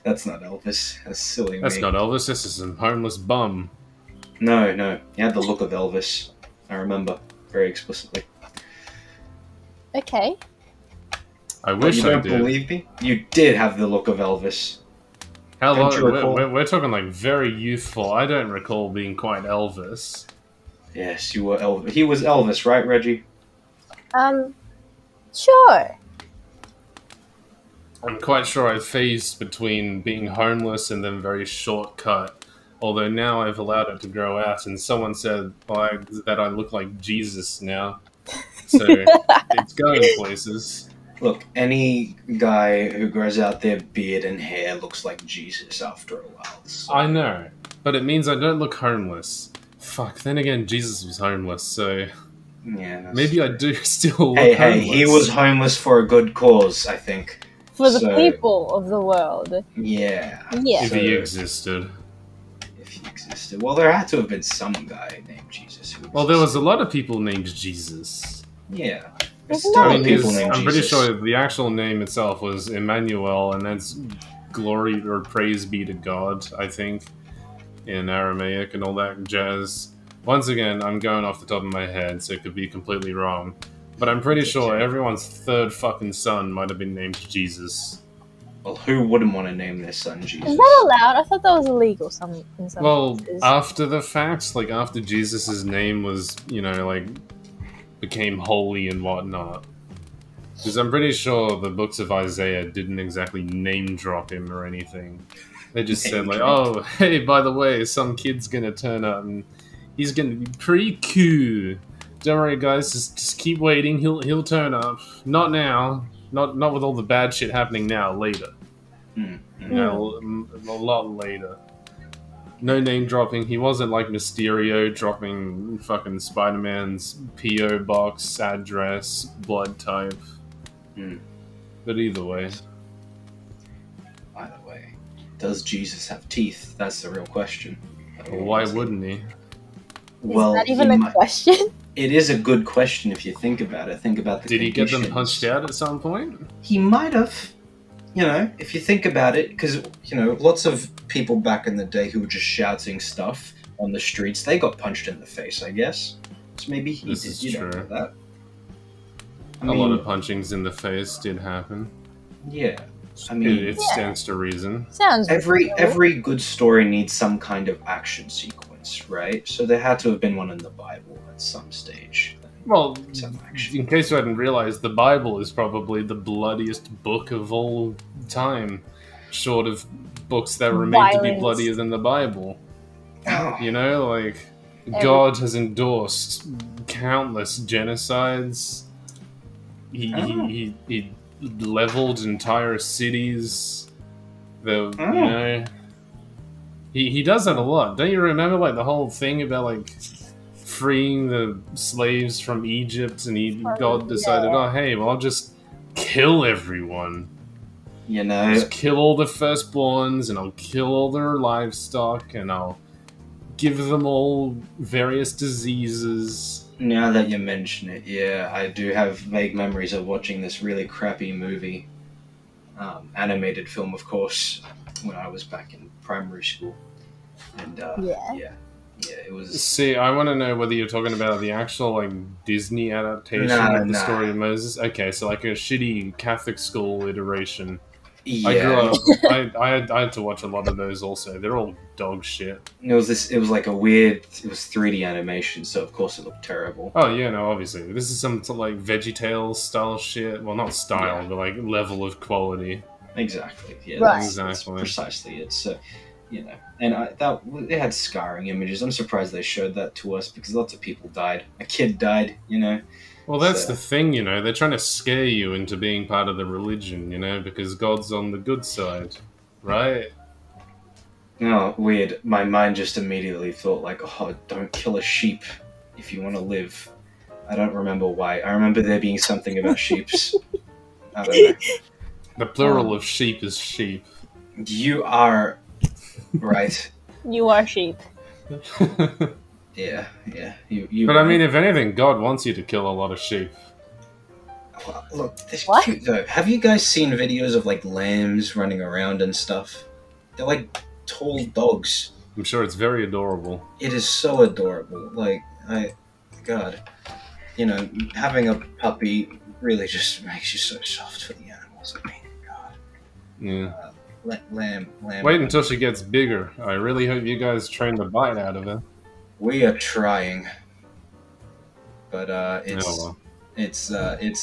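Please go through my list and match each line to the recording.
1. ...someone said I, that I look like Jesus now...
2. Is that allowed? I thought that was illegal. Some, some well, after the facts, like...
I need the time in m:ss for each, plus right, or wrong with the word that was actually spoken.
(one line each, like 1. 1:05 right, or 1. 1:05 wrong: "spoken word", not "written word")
1. 0:34 right
2. 1:30 right.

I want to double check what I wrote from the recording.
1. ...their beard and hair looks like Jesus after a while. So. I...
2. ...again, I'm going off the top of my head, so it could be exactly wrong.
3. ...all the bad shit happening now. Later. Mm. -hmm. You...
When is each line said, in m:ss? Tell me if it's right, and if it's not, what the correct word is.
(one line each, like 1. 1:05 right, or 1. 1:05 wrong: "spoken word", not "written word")
1. 0:43 right
2. 1:20 wrong: "completely", not "exactly"
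3. 1:56 right.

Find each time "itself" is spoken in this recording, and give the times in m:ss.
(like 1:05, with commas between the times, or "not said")
1:12.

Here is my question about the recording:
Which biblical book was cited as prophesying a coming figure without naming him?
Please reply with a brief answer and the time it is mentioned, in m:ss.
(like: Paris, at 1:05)
Isaiah, at 1:42.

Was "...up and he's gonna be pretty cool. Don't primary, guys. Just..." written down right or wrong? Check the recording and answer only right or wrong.
wrong.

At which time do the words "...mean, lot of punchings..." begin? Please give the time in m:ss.
2:39.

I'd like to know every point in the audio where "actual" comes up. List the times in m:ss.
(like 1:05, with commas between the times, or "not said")
1:11, 3:51.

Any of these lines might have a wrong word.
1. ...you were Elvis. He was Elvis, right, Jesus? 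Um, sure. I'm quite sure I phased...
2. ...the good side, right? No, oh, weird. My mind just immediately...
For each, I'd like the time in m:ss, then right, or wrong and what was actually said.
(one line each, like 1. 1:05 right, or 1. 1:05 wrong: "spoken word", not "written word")
1. 0:21 wrong: "Reggie", not "Jesus"
2. 4:28 right.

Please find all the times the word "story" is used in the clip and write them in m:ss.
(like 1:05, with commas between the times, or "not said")
2:46, 3:54.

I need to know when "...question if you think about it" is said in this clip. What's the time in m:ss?
2:22.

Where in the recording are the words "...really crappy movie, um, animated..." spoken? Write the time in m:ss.
3:40.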